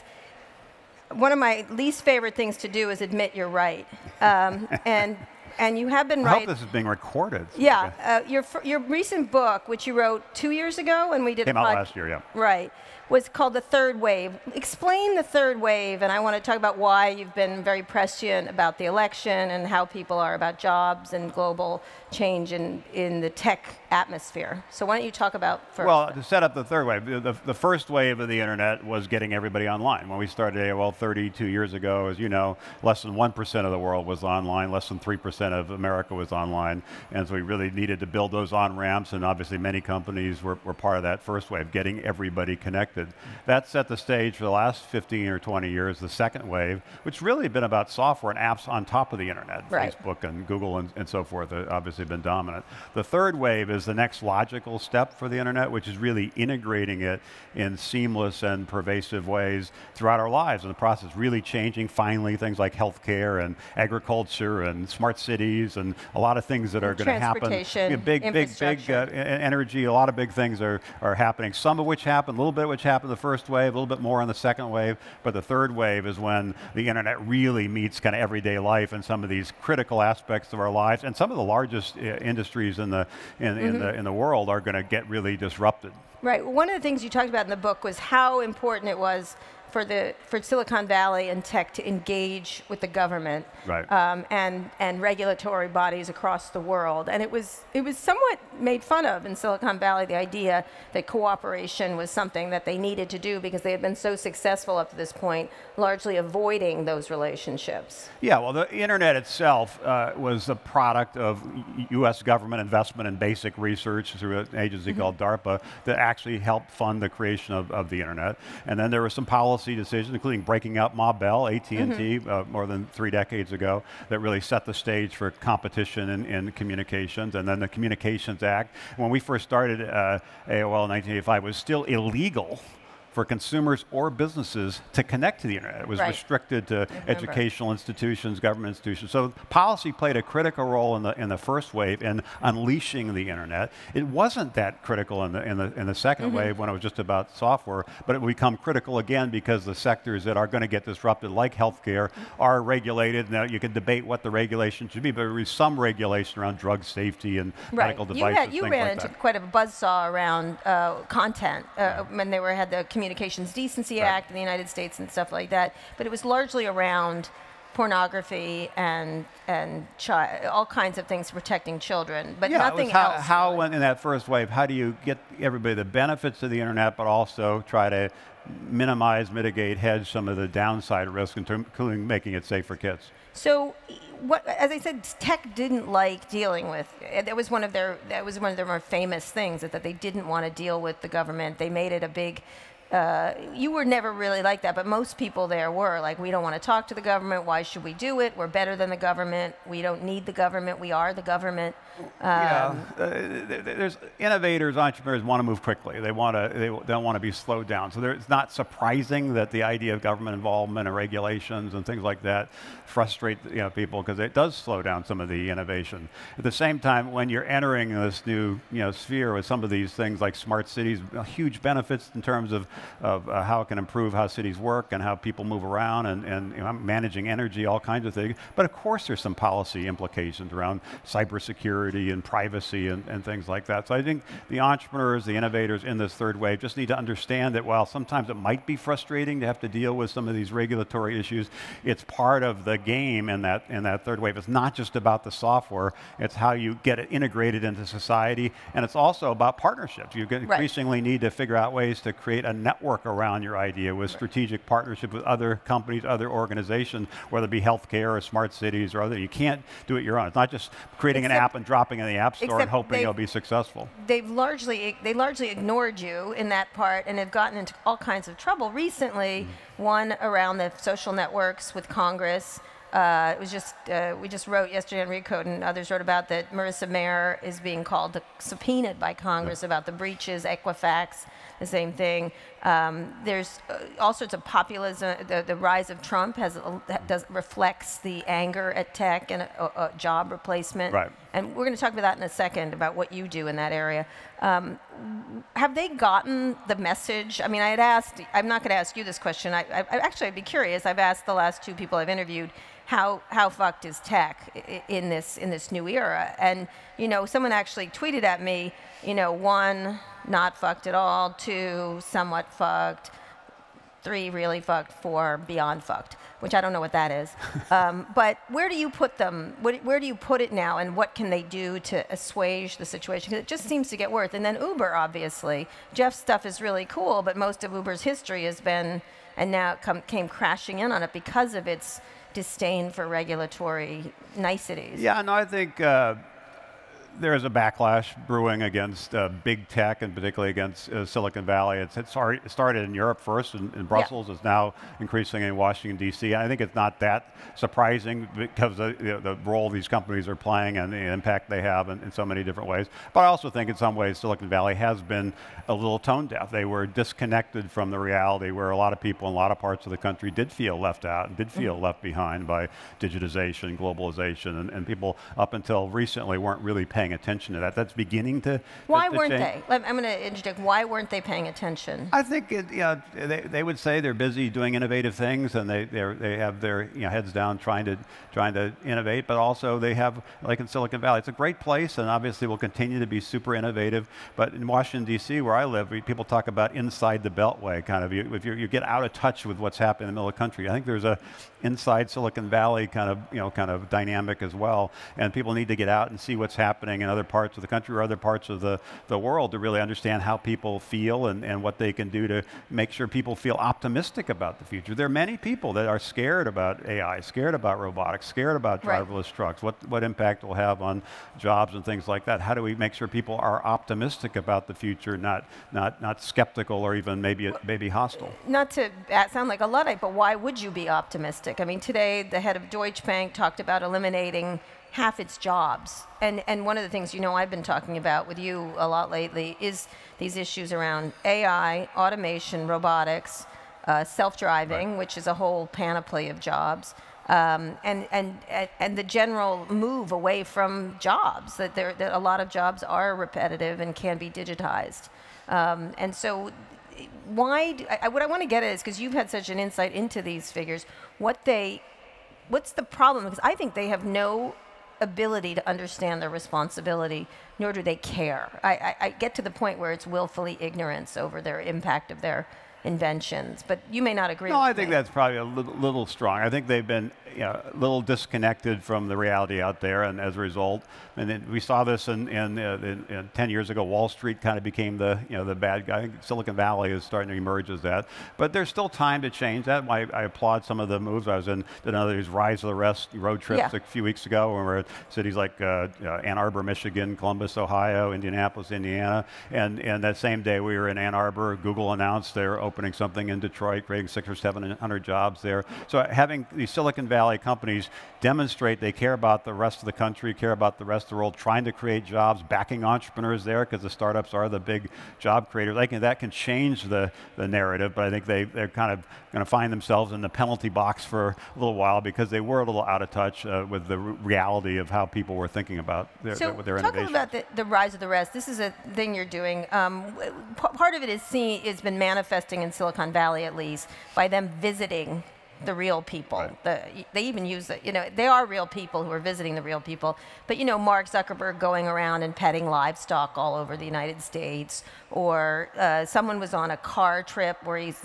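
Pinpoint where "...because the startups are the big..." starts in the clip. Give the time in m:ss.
8:23.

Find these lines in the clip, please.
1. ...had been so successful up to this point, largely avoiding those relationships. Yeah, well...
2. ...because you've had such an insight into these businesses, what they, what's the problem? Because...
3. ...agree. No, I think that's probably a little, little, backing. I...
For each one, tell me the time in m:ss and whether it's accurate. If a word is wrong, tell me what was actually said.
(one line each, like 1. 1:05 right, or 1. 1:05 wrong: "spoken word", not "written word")
1. 1:43 right
2. 7:28 wrong: "figures", not "businesses"
3. 7:44 wrong: "strong", not "backing".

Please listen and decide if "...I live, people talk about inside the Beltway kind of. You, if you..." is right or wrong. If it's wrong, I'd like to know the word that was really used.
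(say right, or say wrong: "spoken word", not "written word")
right.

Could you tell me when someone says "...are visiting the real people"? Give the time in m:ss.
8:49.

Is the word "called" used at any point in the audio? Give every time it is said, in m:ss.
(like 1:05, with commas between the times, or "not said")
0:13, 1:55, 4:37.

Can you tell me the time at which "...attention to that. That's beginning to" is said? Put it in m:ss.
6:07.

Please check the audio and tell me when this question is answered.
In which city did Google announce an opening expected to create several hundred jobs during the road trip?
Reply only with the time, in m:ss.
8:13.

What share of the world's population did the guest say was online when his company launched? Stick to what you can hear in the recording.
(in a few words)
less than 1%.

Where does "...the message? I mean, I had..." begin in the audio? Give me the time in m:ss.
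4:56.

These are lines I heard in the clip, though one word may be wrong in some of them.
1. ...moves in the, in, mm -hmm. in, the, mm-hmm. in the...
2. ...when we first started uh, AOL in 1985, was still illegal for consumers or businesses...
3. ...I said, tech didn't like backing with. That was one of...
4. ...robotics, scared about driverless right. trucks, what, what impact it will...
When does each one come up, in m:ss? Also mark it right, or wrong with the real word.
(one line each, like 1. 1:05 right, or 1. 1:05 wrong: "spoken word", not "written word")
1. 1:22 wrong: "industries", not "moves"
2. 2:08 right
3. 3:04 wrong: "dealing", not "backing"
4. 6:47 right.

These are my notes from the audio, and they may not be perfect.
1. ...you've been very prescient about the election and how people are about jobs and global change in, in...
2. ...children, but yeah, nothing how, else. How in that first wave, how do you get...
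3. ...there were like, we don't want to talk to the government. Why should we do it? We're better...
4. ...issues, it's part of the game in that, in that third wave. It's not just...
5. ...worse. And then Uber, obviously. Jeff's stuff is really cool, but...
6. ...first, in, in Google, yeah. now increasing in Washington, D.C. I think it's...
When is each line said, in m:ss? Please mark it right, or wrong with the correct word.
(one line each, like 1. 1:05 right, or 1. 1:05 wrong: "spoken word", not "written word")
1. 0:17 right
2. 2:51 right
3. 3:15 right
4. 4:01 right
5. 5:24 right
6. 5:43 wrong: "Brussels", not "Google".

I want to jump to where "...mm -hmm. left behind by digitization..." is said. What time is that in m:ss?
6:01.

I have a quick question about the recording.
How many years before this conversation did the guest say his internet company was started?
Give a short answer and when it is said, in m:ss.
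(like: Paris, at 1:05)
32, at 0:30.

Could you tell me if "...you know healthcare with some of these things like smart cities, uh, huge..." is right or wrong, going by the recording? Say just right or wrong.
wrong.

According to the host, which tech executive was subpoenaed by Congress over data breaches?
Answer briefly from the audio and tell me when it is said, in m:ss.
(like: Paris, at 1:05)
Marissa Mayer, at 4:36.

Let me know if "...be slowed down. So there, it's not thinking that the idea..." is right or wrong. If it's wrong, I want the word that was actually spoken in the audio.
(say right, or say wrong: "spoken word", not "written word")
wrong: "surprising", not "thinking".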